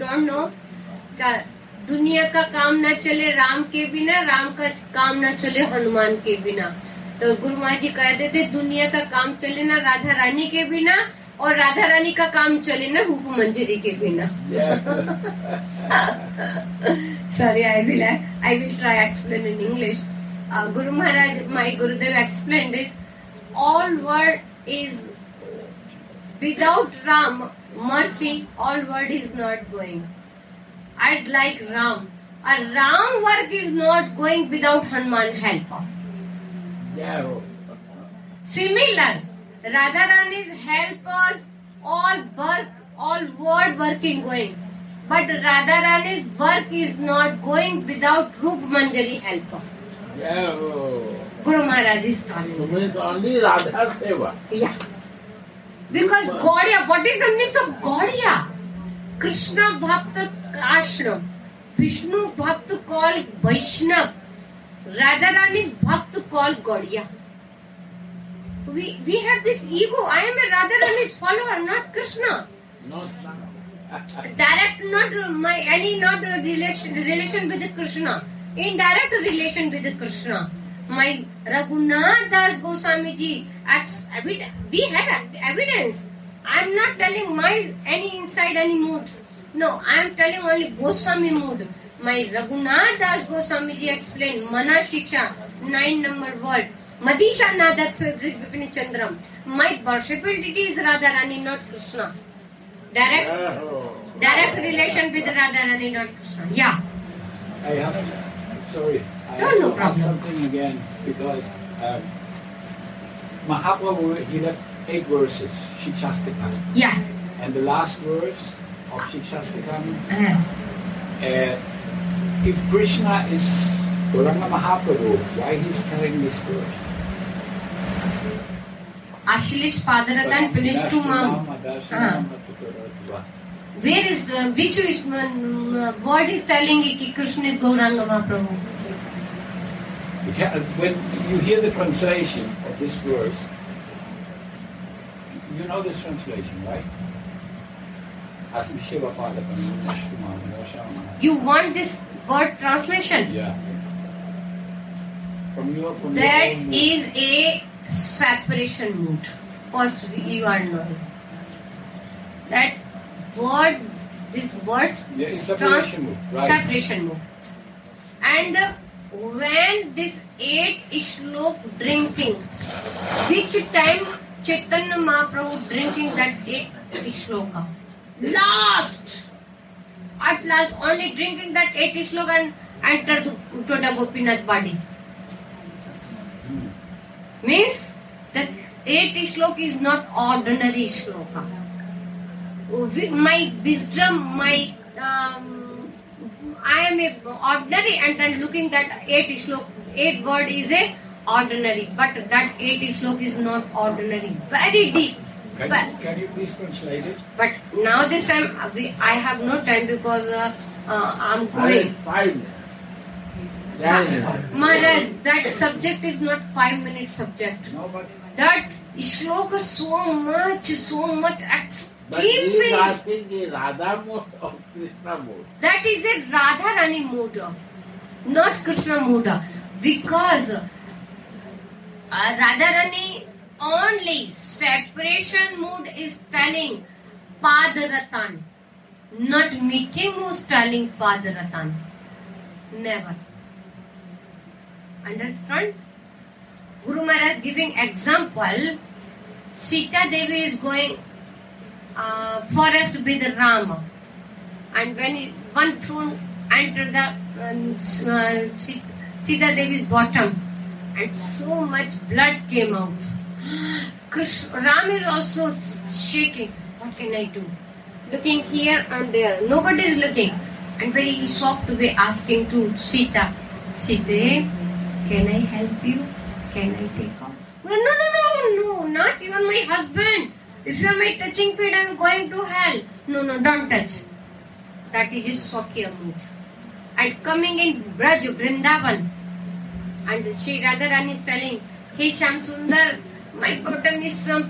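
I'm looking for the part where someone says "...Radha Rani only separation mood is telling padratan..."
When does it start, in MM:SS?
03:52.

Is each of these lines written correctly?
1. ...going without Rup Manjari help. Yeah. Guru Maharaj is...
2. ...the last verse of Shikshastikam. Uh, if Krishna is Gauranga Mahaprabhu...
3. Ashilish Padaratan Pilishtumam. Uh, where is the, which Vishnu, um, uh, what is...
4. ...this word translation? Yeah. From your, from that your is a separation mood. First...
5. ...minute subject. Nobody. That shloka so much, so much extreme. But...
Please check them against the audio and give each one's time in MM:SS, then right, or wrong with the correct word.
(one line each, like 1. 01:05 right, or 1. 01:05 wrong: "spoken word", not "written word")
1. 00:47 right
2. 01:57 right
3. 02:09 right
4. 02:31 right
5. 03:36 right.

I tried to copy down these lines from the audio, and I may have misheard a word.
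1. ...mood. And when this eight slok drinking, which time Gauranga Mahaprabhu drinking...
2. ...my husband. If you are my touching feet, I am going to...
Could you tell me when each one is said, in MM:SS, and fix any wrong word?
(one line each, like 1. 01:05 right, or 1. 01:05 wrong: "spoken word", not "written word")
1. 02:47 wrong: "Chaitanya", not "Gauranga"
2. 04:39 right.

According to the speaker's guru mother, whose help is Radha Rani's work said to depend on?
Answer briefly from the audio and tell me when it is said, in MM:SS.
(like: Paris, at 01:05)
Rup Manjari, at 00:13.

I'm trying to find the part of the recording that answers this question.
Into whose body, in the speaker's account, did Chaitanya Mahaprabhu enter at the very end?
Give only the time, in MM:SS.
03:03.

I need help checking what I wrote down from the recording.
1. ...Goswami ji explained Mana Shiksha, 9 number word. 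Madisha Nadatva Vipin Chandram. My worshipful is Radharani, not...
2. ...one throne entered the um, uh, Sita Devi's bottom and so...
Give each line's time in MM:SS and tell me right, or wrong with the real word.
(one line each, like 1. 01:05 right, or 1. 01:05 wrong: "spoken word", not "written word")
1. 01:33 right
2. 04:15 right.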